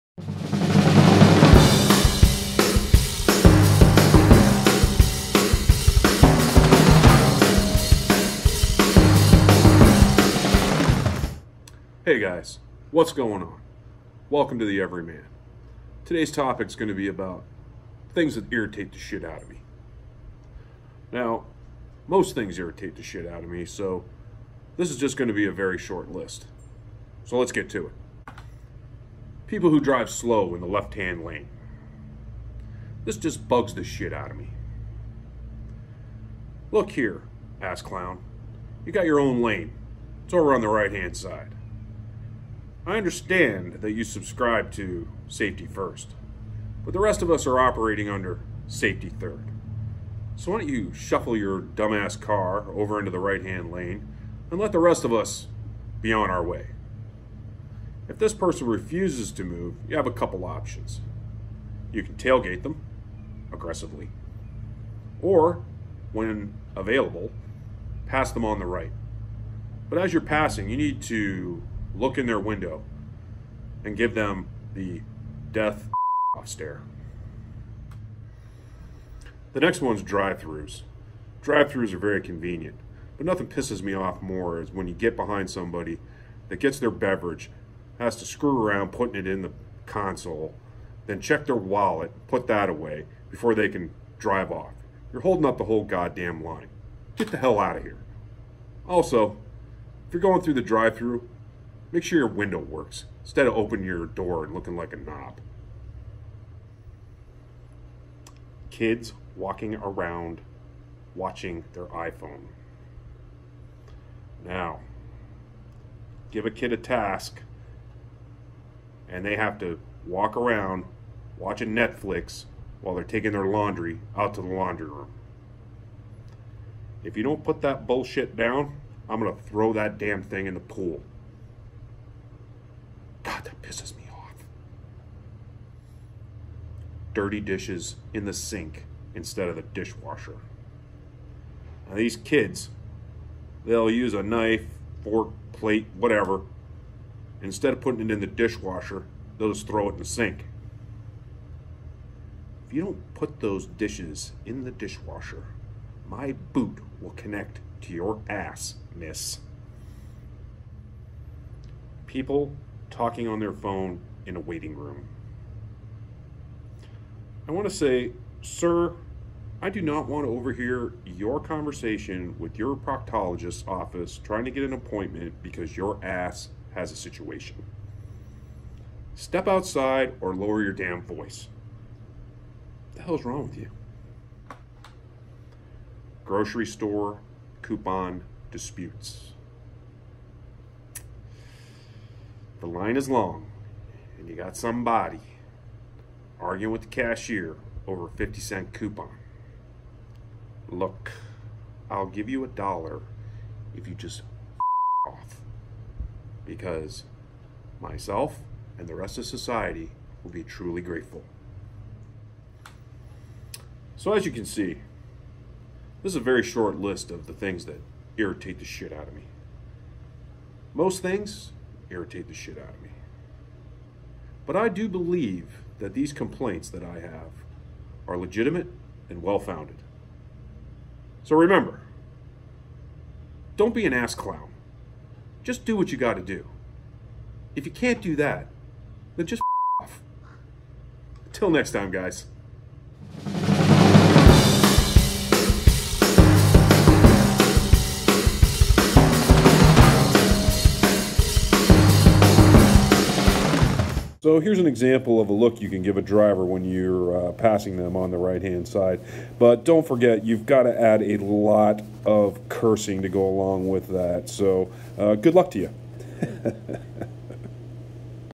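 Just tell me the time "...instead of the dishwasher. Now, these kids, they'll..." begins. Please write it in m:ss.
2:19.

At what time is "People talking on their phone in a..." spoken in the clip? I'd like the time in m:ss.
2:42.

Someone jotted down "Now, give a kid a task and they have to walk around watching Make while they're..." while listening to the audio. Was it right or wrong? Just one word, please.
wrong.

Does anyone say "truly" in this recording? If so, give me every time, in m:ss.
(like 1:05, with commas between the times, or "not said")
3:30.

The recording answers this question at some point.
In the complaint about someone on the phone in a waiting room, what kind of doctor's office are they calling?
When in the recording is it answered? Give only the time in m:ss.
2:52.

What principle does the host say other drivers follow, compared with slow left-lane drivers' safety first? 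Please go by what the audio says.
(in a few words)
safety third.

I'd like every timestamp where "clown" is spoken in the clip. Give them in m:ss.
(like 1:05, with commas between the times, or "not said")
0:37, 3:54.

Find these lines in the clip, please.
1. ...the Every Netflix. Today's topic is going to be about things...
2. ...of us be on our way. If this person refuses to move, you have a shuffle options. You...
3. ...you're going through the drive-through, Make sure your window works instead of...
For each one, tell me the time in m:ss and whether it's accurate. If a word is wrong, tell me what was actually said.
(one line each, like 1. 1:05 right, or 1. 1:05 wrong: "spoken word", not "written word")
1. 0:14 wrong: "Man", not "Netflix"
2. 0:55 wrong: "couple", not "shuffle"
3. 1:40 right.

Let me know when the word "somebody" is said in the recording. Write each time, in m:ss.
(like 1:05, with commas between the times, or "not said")
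1:25, 3:14.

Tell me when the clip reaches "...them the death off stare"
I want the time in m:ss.
1:14.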